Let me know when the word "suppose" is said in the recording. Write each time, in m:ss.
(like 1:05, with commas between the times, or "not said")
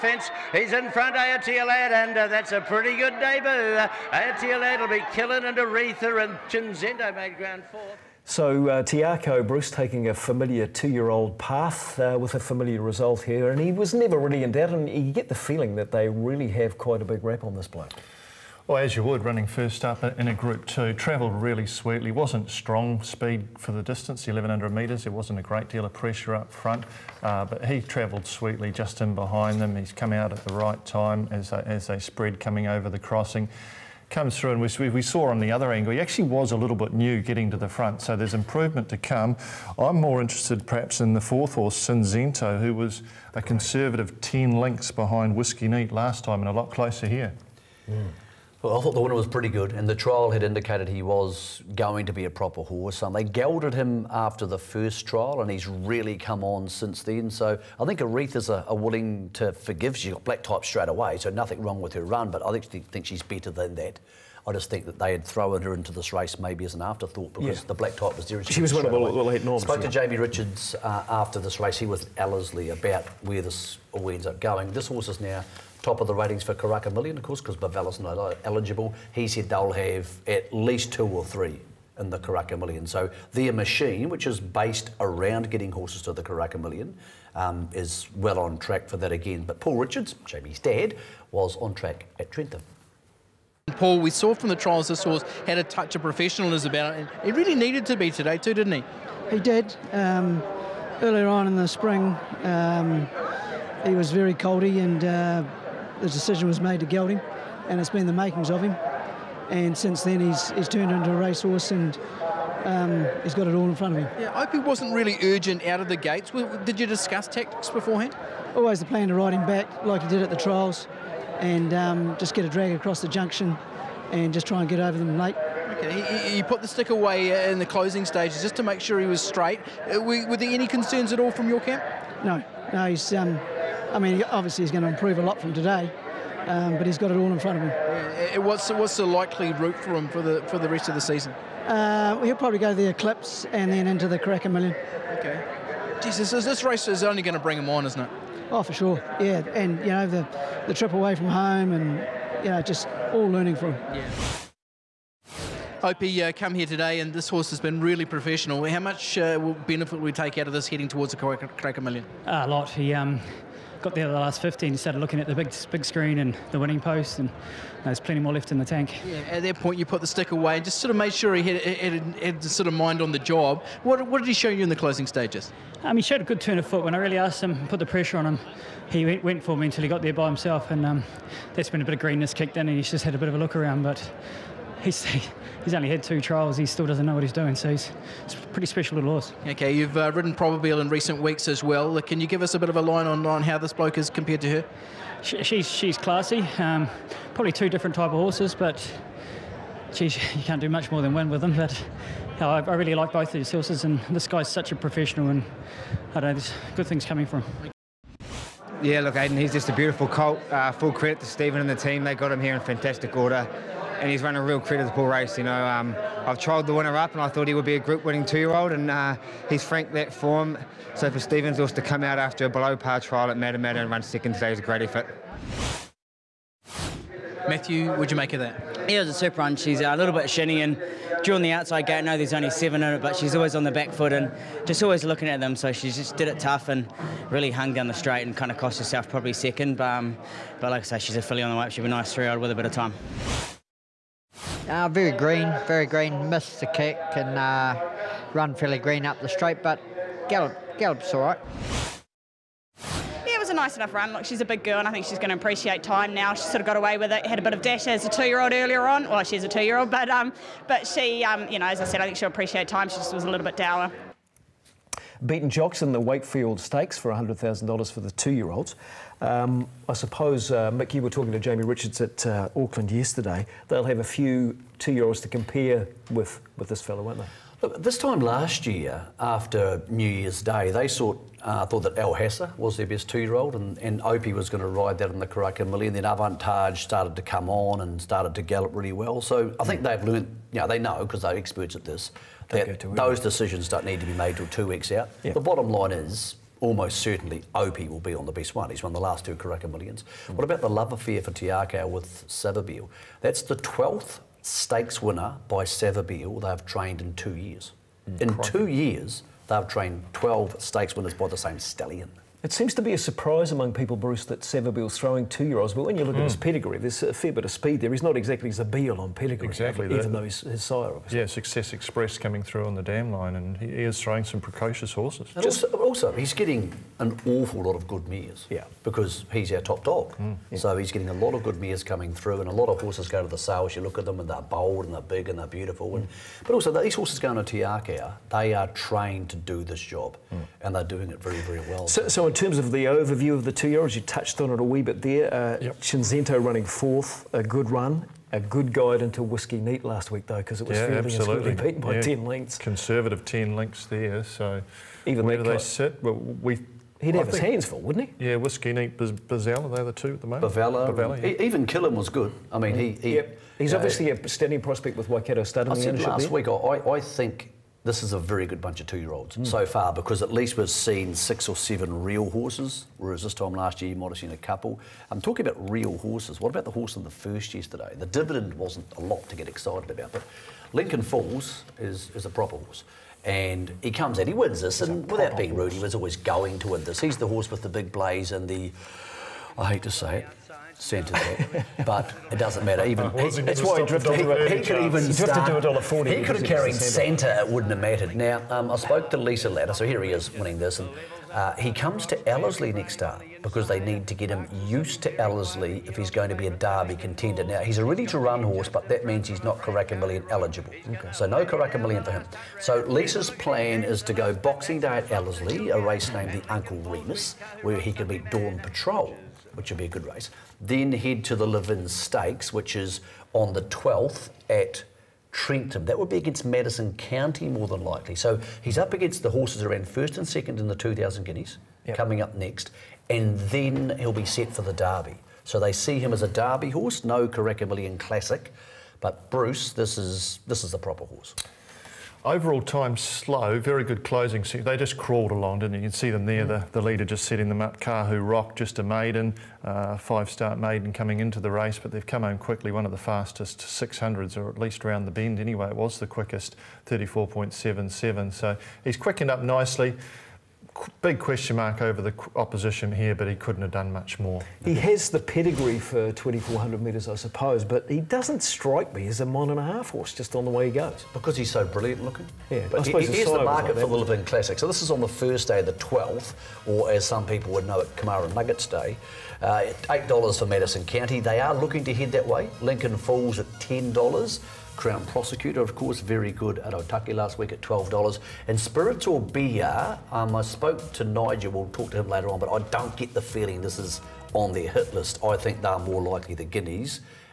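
4:29, 7:47, 7:52.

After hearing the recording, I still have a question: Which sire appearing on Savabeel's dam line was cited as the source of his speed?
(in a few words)
Success Express.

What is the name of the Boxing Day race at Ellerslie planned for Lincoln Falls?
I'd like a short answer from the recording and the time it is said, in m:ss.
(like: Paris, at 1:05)
Uncle Remus, at 6:56.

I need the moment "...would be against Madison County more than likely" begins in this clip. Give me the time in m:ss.
7:05.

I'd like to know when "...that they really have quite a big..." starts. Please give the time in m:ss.
0:15.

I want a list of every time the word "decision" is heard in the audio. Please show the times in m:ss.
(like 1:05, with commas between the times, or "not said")
1:46, 4:53.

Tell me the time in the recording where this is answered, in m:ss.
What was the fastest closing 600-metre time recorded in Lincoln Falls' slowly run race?
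7:36.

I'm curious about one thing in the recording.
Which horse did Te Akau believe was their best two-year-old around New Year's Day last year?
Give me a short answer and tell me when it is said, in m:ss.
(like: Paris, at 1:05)
Al Hassa, at 4:41.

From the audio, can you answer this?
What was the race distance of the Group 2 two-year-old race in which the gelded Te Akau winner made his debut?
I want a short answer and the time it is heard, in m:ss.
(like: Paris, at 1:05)
1100 metres, at 0:24.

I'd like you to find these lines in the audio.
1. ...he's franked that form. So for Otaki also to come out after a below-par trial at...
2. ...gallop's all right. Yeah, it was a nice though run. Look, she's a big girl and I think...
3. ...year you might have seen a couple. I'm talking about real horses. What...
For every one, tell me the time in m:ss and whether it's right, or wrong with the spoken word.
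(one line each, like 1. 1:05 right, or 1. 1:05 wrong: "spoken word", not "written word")
1. 3:39 wrong: "Stevens", not "Otaki"
2. 4:10 wrong: "enough", not "though"
3. 6:13 right.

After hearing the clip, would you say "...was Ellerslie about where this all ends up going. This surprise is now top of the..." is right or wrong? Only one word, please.
wrong.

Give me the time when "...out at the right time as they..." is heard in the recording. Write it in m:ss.
0:30.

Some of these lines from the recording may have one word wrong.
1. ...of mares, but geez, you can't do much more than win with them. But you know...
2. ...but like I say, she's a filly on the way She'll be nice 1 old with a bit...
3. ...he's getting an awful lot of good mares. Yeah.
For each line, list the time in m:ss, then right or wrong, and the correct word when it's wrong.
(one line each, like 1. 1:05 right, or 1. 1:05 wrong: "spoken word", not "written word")
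1. 3:18 wrong: "horses", not "mares"
2. 4:00 wrong: "3", not "1"
3. 5:26 right.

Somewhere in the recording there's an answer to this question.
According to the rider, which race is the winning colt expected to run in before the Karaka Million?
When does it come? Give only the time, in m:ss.
2:22.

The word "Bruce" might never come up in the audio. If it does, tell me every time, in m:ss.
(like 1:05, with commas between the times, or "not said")
0:09, 5:13, 7:19.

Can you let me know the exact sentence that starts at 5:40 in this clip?
and they're doing it very, very well.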